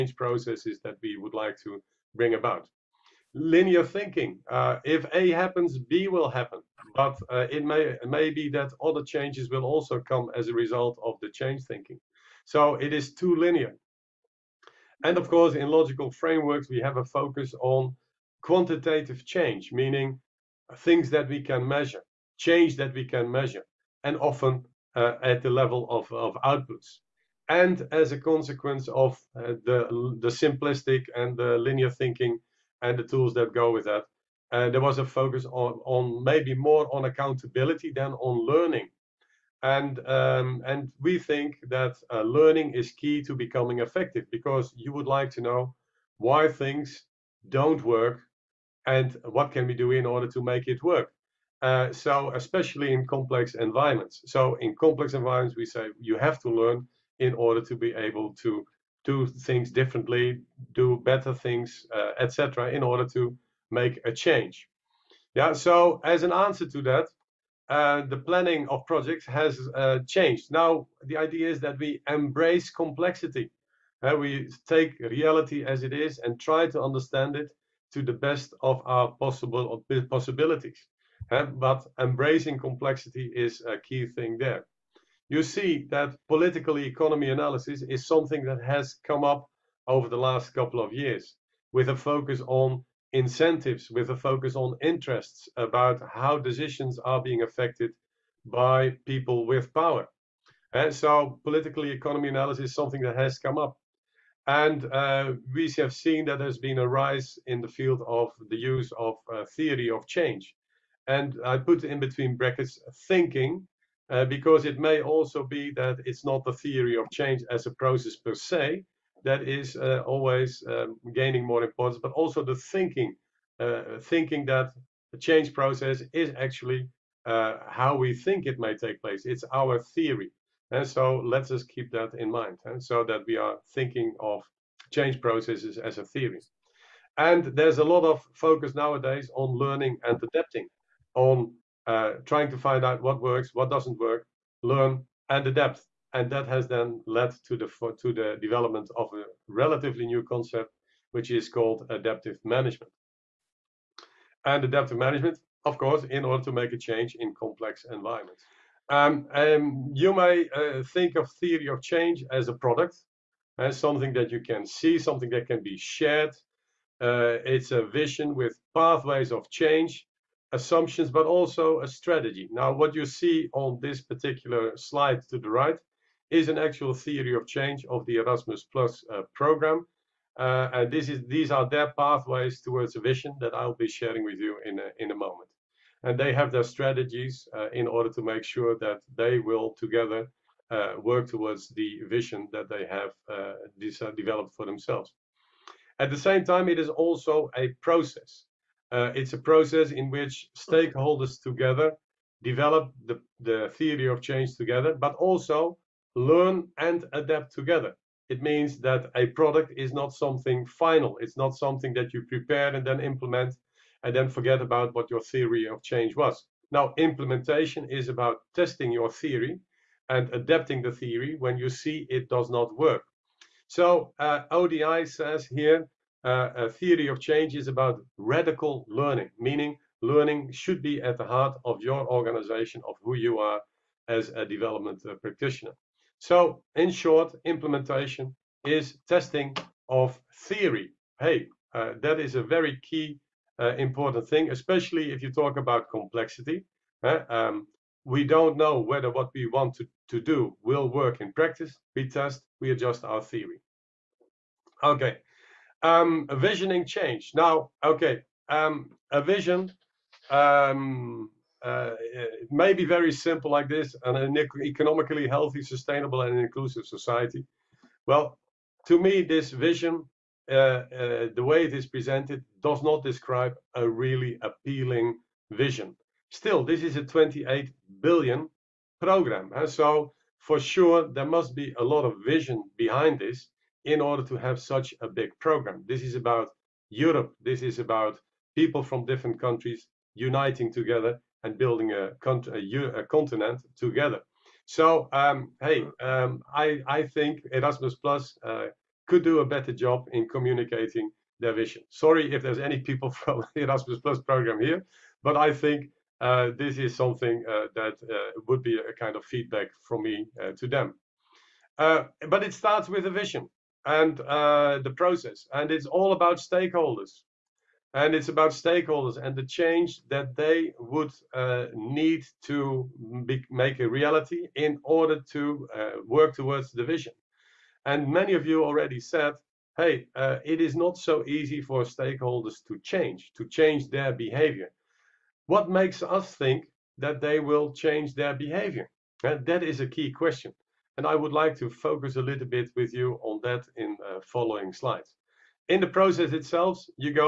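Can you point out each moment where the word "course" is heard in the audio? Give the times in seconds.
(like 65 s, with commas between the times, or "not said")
15 s, 155 s.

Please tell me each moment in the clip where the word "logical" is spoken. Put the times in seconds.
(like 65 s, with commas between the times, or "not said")
15 s.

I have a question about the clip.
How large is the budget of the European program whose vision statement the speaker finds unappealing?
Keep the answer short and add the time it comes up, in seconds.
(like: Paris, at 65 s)
28 billion, at 277 s.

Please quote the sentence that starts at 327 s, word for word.
And many of you already said, hey, uh, it is not so easy for stakeholders to change, to change their behavior.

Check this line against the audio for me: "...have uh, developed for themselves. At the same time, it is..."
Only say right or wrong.
right.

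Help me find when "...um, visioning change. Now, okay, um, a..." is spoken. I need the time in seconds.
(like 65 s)
255 s.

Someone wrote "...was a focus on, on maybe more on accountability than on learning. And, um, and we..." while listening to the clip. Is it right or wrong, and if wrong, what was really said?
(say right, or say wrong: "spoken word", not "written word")
right.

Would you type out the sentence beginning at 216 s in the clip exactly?
Now, implementation is about testing your theory and adapting the theory when you see it does not work.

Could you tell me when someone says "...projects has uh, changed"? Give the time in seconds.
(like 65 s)
68 s.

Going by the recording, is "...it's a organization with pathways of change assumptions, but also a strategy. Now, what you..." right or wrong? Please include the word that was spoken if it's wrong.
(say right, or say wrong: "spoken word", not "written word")
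wrong: "vision", not "organization".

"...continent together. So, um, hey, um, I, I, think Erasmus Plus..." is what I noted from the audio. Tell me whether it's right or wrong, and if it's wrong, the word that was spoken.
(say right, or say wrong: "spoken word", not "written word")
right.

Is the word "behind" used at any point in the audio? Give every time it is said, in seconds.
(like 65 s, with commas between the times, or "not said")
282 s.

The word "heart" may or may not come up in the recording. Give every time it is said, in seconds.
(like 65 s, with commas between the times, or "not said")
231 s.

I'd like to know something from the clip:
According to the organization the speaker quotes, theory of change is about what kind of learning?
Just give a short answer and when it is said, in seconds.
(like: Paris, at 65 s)
radical learning, at 228 s.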